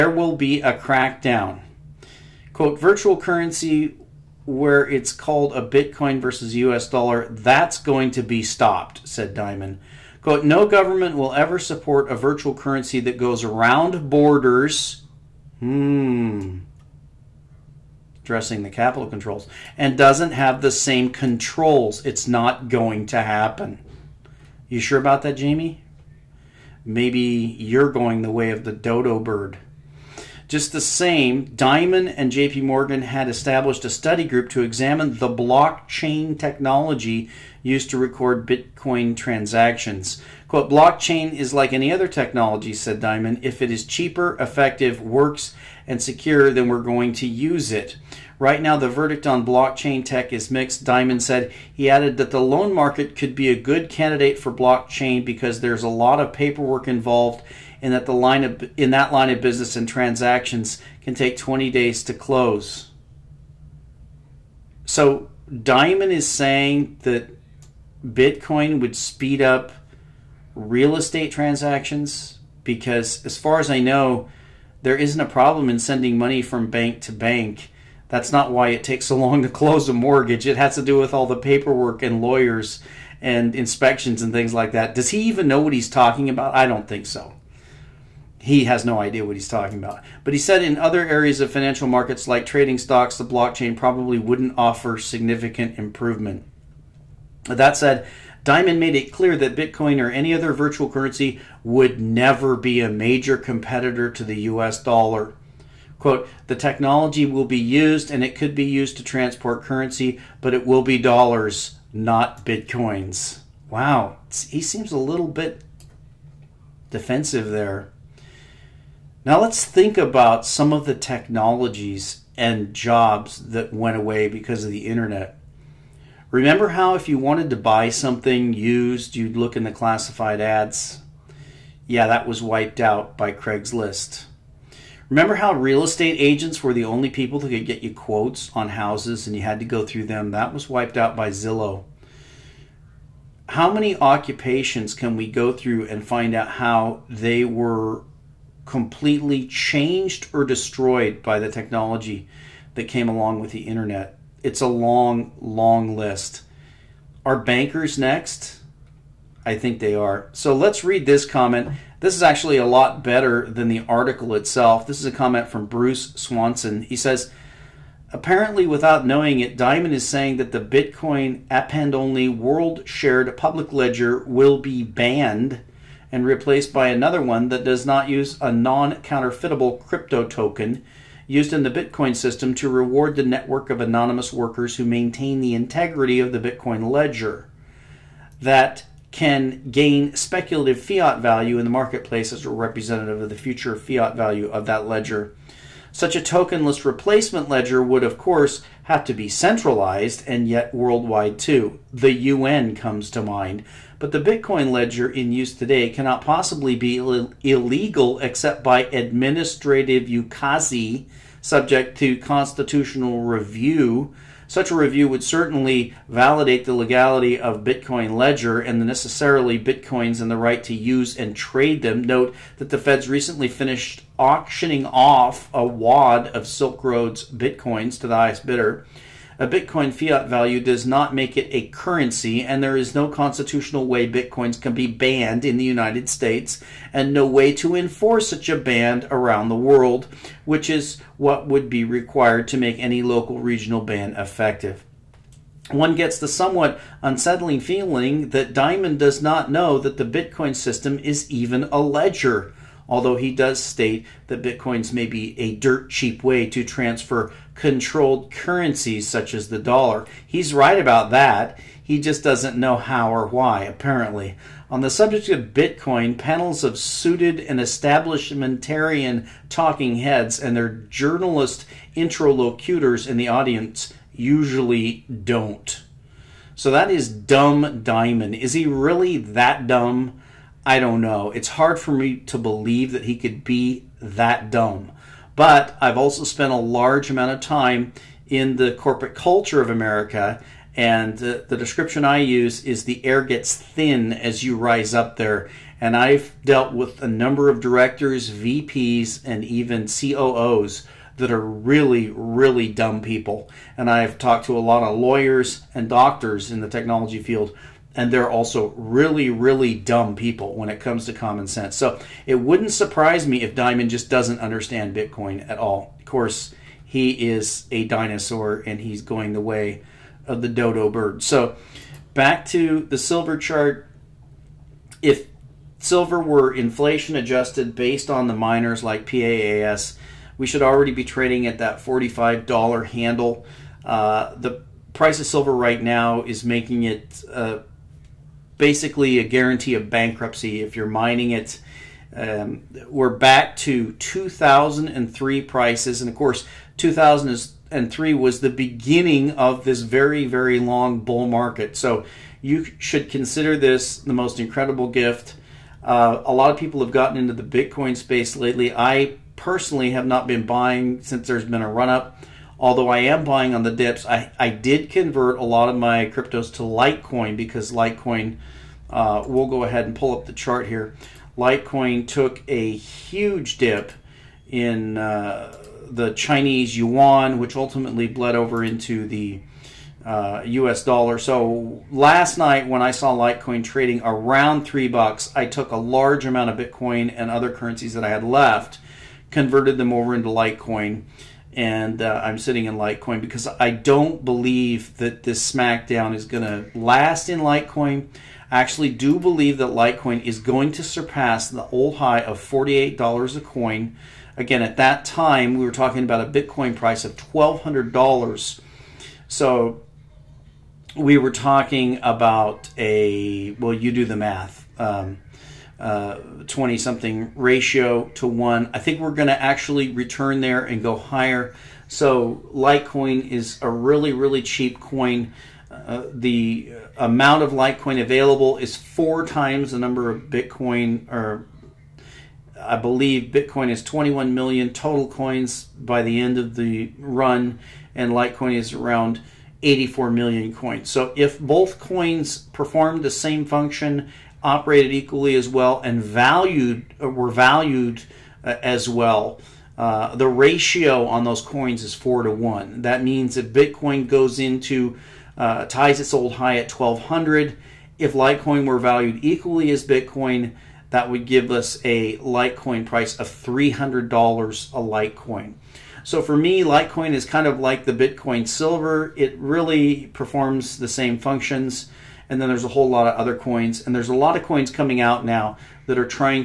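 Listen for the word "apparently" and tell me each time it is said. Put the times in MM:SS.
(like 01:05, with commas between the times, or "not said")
02:48, 04:23.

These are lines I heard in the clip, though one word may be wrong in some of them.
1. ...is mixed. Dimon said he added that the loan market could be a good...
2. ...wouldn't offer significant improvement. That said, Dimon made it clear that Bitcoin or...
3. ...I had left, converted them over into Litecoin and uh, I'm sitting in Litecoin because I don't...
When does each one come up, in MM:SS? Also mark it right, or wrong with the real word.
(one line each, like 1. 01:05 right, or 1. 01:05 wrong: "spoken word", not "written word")
1. 00:50 right
2. 01:34 right
3. 06:28 right.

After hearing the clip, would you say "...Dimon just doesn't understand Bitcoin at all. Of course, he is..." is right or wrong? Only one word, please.
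right.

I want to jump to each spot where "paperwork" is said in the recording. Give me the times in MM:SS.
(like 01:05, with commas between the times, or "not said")
00:56, 01:21.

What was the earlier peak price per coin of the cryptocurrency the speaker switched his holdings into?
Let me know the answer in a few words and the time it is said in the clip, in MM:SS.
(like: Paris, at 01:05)
$48, at 06:42.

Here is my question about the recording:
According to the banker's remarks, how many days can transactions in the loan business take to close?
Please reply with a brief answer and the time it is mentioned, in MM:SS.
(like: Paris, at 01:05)
20 days, at 01:01.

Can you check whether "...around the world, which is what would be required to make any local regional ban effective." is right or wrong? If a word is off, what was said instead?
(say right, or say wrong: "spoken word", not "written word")
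right.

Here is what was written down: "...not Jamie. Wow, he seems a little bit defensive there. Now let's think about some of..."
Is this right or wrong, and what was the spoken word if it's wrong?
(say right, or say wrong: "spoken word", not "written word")
wrong: "Bitcoins", not "Jamie".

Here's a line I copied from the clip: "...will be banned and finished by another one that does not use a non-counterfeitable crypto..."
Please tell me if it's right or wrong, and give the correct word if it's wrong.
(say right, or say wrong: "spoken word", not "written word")
wrong: "replaced", not "finished".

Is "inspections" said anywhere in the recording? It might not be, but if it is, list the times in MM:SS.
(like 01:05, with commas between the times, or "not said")
01:23.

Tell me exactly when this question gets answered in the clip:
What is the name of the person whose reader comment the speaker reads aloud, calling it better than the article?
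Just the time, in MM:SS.
02:45.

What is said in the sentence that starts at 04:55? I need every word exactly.
And I've dealt with a number of directors, VPs, and even COOs that are really, really dumb people.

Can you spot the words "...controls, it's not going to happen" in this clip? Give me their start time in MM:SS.
00:21.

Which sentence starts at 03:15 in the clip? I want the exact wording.
Such a tokenless replacement ledger would, of course, have to be centralized and yet worldwide too.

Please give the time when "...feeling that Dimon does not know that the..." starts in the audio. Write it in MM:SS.
04:07.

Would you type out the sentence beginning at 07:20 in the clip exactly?
So if both coins perform the same function operated equally as well and valued uh, were valued uh, as well.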